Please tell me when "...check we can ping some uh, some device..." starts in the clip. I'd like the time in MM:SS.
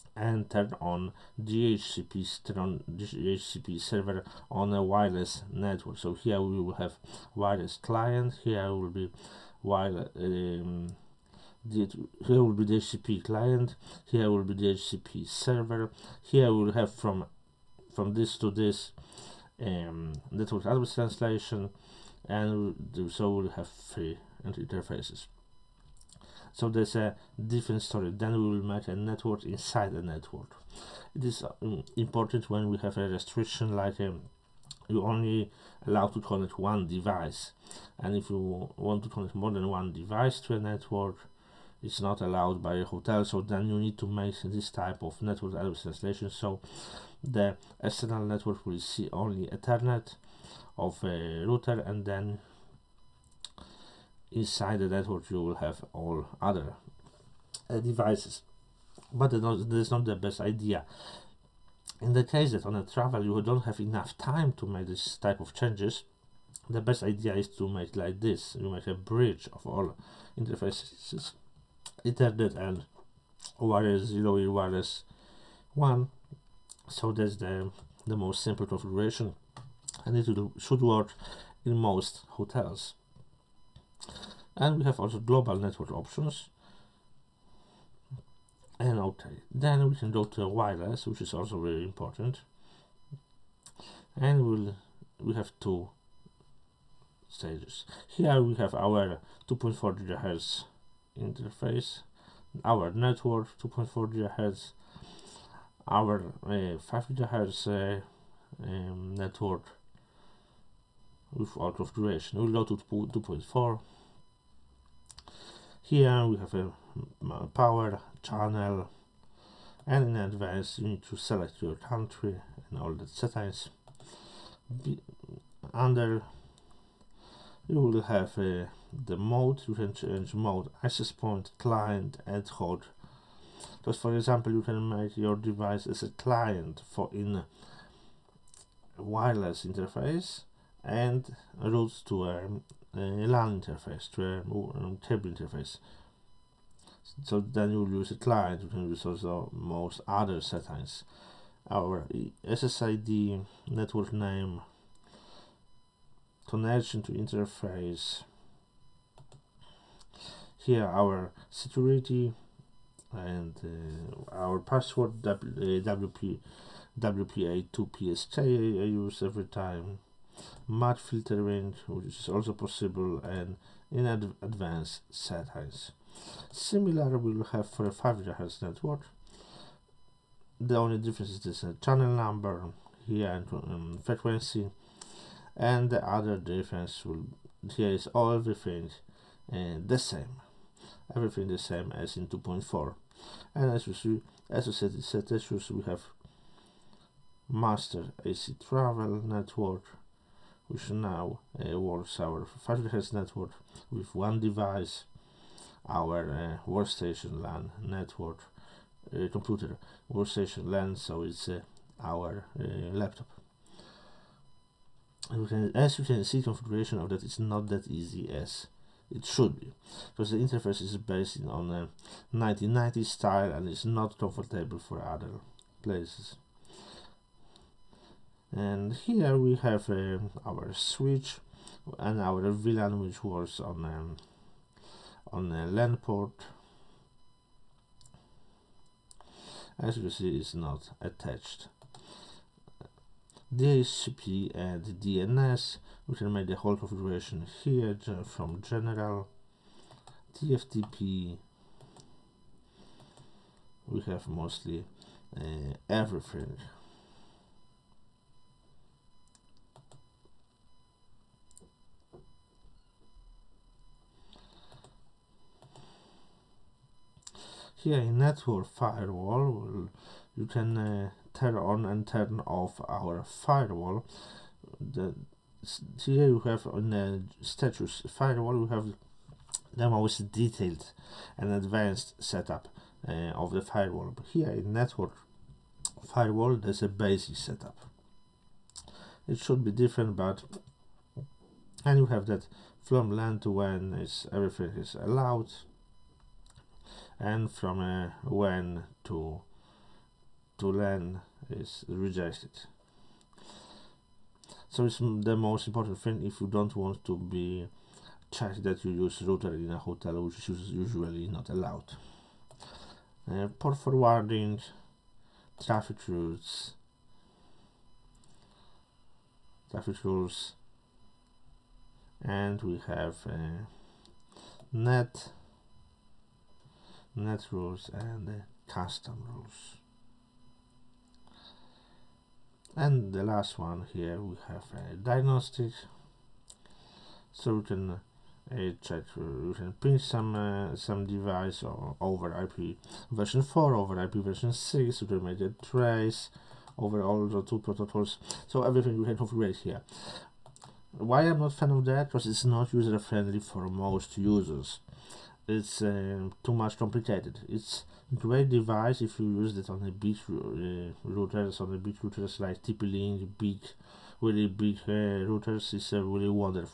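05:38.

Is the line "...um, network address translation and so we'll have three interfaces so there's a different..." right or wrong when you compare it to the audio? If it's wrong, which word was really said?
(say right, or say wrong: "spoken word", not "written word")
right.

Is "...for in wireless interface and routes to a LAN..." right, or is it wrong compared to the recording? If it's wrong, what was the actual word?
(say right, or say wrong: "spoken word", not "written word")
right.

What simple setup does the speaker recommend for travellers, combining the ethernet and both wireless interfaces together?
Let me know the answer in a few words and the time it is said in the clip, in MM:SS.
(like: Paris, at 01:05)
A bridge, at 01:08.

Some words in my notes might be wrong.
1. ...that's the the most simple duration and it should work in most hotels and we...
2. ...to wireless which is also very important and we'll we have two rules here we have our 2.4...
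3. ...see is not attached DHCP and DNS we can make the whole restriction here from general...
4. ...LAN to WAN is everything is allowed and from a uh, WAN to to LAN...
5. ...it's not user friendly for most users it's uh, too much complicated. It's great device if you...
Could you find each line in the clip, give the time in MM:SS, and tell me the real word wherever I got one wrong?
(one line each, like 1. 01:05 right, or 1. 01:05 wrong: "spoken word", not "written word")
1. 01:17 wrong: "configuration", not "duration"
2. 01:30 wrong: "stages", not "rules"
3. 04:00 wrong: "configuration", not "restriction"
4. 04:53 right
5. 05:52 right.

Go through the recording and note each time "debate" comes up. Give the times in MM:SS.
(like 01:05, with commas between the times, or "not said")
not said.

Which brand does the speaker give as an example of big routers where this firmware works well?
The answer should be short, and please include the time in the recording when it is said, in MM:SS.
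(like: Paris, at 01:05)
TP-Link, at 06:02.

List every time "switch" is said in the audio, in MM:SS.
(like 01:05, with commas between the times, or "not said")
03:50.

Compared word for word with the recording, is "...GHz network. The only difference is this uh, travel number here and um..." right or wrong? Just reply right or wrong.
wrong.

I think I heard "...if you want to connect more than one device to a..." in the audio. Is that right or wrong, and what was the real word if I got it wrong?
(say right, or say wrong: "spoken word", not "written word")
right.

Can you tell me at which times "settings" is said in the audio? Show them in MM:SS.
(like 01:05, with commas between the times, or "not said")
02:03, 02:30, 02:55.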